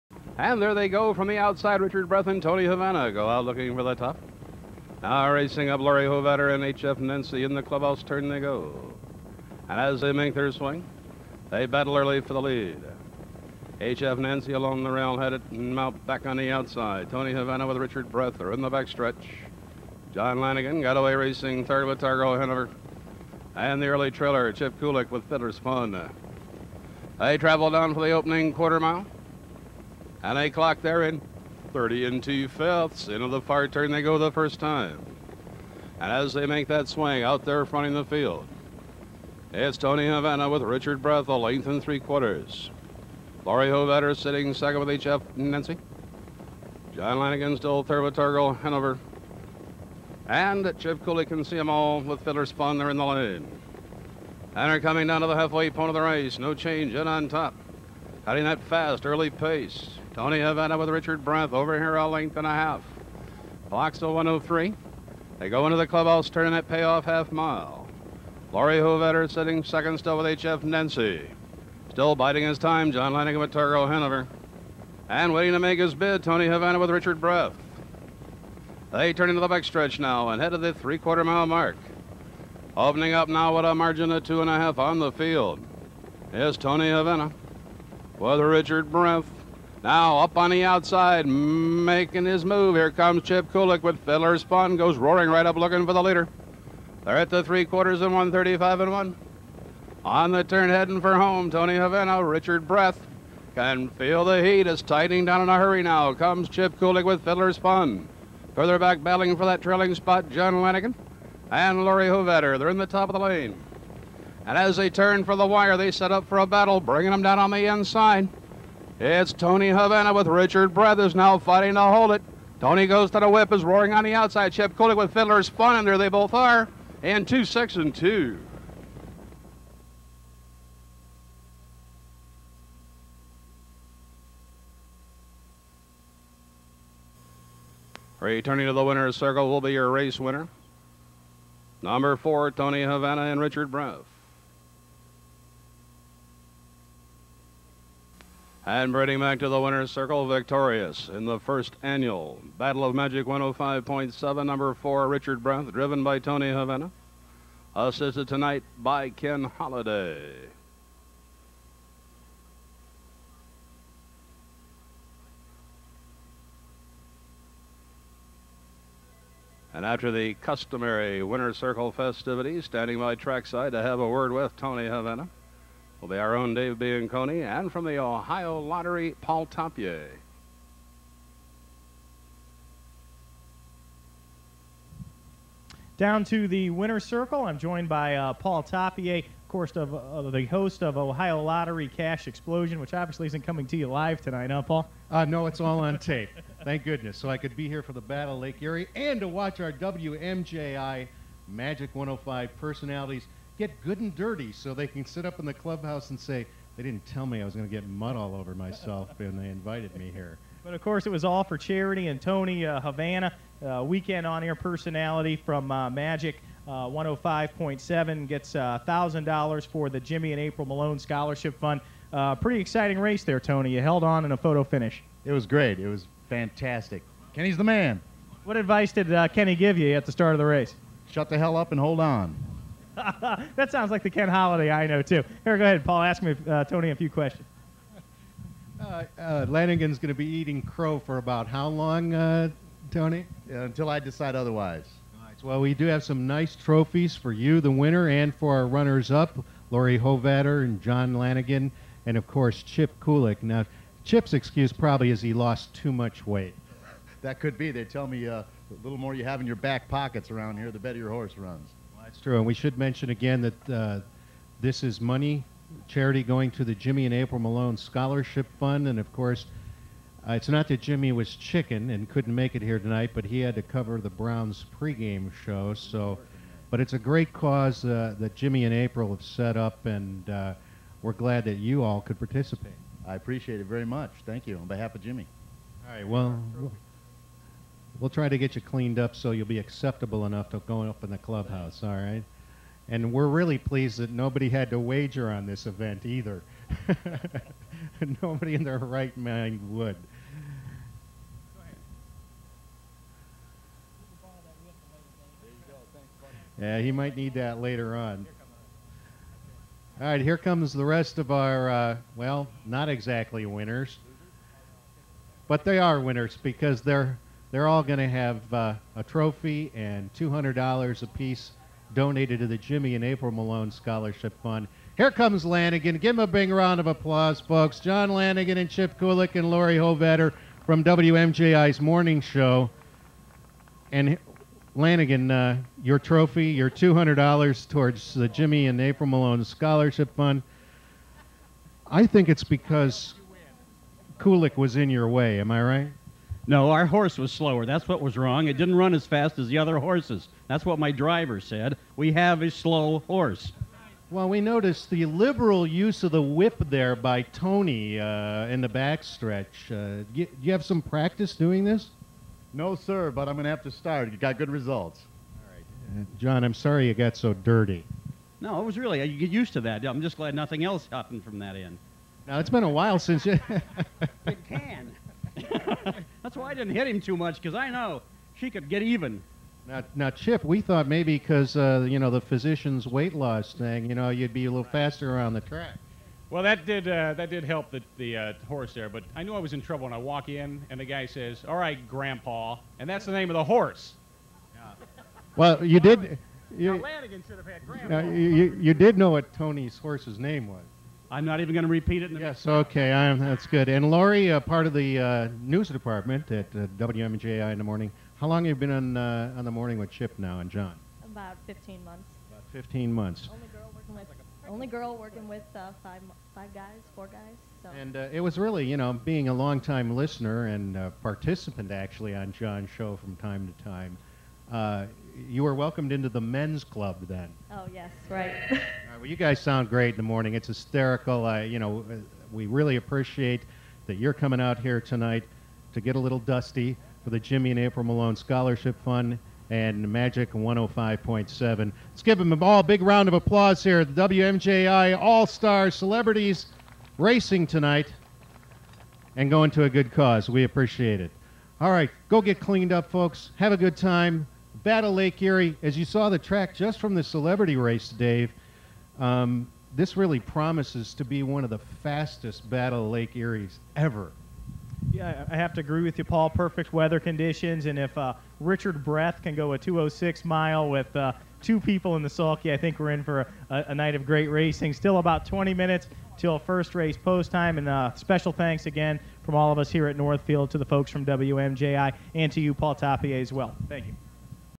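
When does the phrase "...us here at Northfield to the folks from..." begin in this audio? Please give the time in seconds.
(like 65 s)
479 s.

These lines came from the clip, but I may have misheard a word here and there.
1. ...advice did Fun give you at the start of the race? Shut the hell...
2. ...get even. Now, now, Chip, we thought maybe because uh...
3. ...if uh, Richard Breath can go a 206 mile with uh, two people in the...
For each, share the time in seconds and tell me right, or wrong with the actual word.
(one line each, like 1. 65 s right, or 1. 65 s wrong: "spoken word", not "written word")
1. 228 s wrong: "Kenny", not "Fun"
2. 378 s right
3. 467 s right.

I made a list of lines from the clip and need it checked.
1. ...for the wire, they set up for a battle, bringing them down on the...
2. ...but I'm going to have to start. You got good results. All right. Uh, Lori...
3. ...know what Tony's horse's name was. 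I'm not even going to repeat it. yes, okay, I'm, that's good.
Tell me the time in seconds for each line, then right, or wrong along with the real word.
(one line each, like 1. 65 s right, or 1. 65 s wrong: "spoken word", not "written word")
1. 115 s right
2. 363 s wrong: "John", not "Lori"
3. 398 s right.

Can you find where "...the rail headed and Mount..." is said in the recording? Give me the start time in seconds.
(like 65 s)
14 s.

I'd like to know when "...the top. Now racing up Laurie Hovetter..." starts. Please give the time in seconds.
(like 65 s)
3 s.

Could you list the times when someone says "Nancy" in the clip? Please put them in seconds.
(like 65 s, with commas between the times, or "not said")
6 s, 14 s, 45 s, 70 s.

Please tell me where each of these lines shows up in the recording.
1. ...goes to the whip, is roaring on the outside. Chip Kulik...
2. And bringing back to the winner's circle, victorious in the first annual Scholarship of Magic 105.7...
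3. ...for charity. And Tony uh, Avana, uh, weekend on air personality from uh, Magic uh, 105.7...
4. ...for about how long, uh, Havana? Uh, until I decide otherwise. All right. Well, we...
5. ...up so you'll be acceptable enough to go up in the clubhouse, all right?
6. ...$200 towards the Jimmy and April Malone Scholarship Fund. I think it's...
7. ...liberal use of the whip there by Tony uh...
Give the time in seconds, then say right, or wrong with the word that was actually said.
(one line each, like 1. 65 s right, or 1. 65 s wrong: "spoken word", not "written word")
1. 122 s right
2. 148 s wrong: "Battle", not "Scholarship"
3. 211 s right
4. 240 s wrong: "Tony", not "Havana"
5. 288 s right
6. 336 s right
7. 355 s right.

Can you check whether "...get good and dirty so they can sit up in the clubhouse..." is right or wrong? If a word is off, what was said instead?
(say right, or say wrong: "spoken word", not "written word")
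right.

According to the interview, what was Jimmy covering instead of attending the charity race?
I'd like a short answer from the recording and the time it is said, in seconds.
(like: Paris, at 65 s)
Browns pregame show, at 274 s.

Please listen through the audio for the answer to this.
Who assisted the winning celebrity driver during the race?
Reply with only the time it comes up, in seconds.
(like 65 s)
159 s.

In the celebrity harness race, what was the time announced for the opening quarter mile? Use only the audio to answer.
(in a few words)
30 and 2/5.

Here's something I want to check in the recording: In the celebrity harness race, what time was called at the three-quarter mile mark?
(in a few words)
1:35 and 1.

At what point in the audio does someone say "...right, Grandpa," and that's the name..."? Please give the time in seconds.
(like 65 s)
391 s.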